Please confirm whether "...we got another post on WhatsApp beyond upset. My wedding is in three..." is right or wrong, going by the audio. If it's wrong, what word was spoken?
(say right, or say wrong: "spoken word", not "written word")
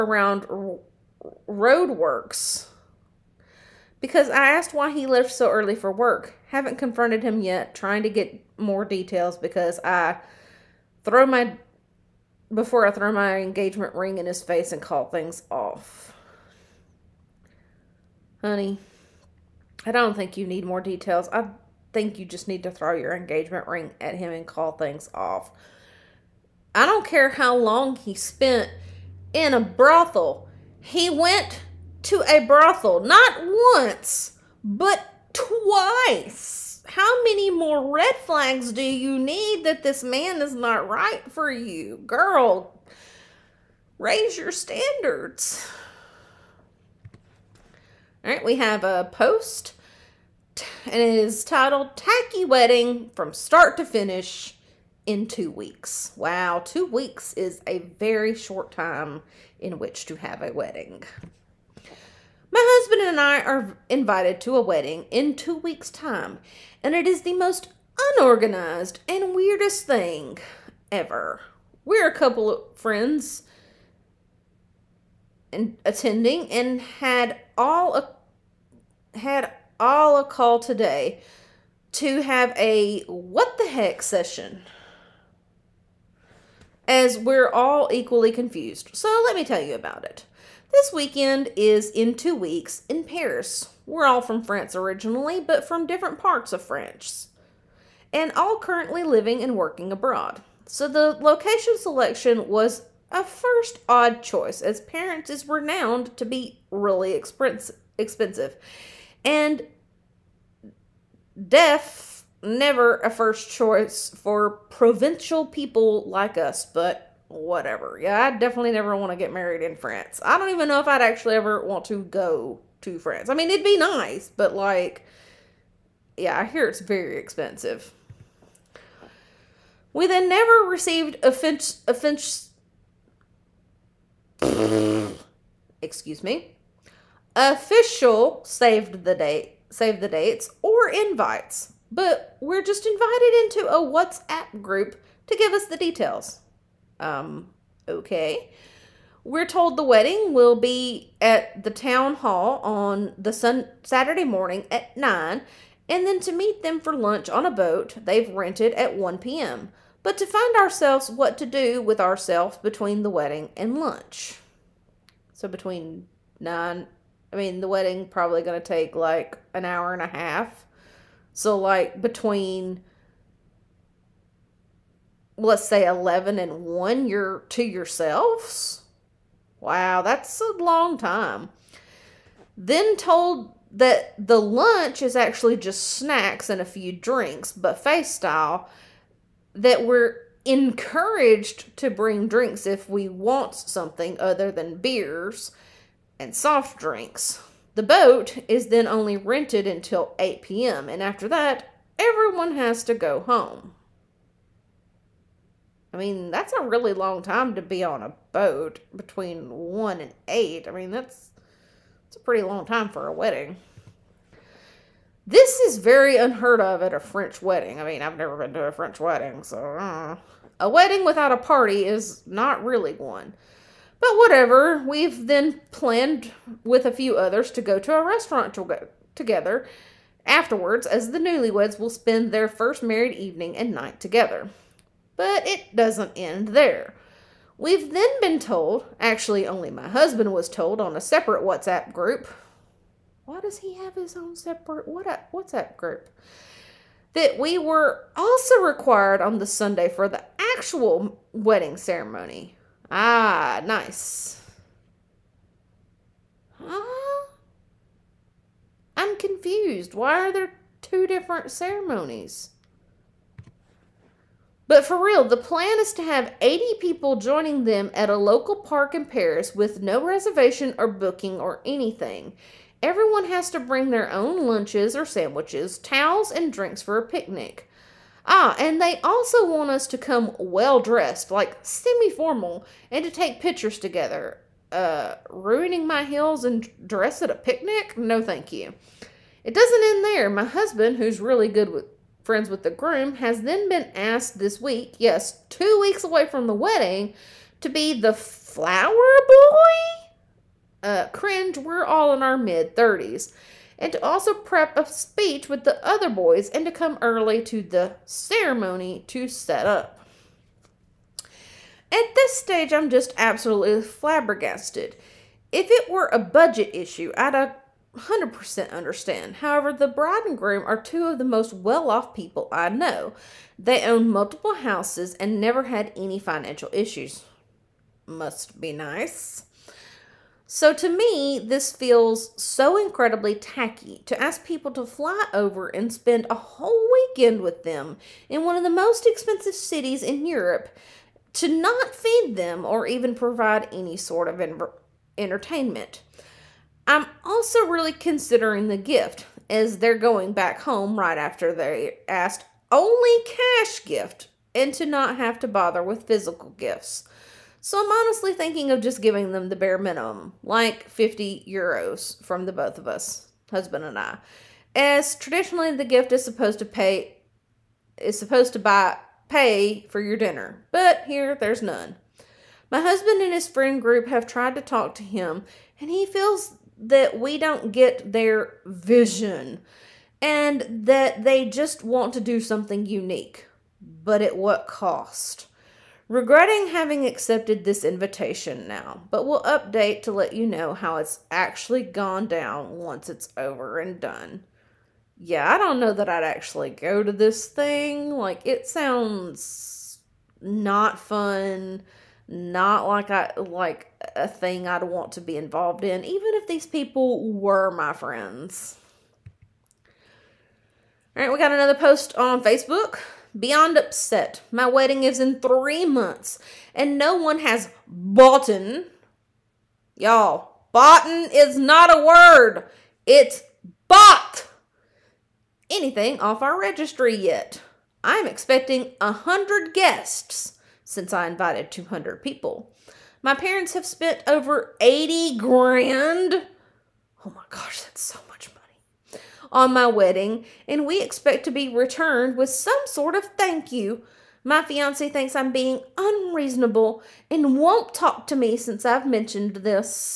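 wrong: "Facebook", not "WhatsApp".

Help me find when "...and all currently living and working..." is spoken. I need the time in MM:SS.
01:38.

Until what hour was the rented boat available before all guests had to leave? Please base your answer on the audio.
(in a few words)
8 p.m.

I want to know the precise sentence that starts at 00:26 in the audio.
I don't care how long he spent in a brothel.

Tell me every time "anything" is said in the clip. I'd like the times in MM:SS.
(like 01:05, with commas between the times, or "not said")
04:31, 07:05.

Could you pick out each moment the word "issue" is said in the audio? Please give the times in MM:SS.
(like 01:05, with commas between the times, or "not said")
05:16, 05:26.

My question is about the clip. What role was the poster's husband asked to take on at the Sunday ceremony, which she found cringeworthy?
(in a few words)
flower boy.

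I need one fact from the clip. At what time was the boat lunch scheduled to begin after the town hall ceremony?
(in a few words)
1 p.m.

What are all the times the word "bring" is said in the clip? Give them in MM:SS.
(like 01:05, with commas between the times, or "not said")
03:11, 04:33.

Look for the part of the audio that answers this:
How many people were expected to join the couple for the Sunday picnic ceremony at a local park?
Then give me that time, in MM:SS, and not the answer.
04:26.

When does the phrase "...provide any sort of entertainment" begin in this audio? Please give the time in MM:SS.
05:43.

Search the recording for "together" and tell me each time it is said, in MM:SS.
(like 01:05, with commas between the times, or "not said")
03:49, 03:53, 04:43.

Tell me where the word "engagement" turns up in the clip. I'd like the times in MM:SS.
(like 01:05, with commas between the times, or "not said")
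00:13, 00:23.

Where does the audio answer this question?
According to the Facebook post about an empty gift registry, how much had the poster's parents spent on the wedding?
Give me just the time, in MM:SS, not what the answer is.
07:14.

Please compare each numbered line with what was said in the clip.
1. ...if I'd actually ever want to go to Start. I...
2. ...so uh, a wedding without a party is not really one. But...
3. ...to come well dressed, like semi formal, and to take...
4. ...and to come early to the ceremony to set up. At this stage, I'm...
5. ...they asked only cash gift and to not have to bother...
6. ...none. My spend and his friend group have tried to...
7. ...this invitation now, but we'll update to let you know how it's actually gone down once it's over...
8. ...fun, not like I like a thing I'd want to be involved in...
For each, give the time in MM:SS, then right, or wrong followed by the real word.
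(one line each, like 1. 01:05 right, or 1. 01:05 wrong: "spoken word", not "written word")
1. 02:00 wrong: "France", not "Start"
2. 03:39 right
3. 04:39 right
4. 05:06 right
5. 05:51 right
6. 06:11 wrong: "husband", not "spend"
7. 06:27 right
8. 06:40 right.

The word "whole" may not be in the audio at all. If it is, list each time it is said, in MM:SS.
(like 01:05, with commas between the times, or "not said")
05:36.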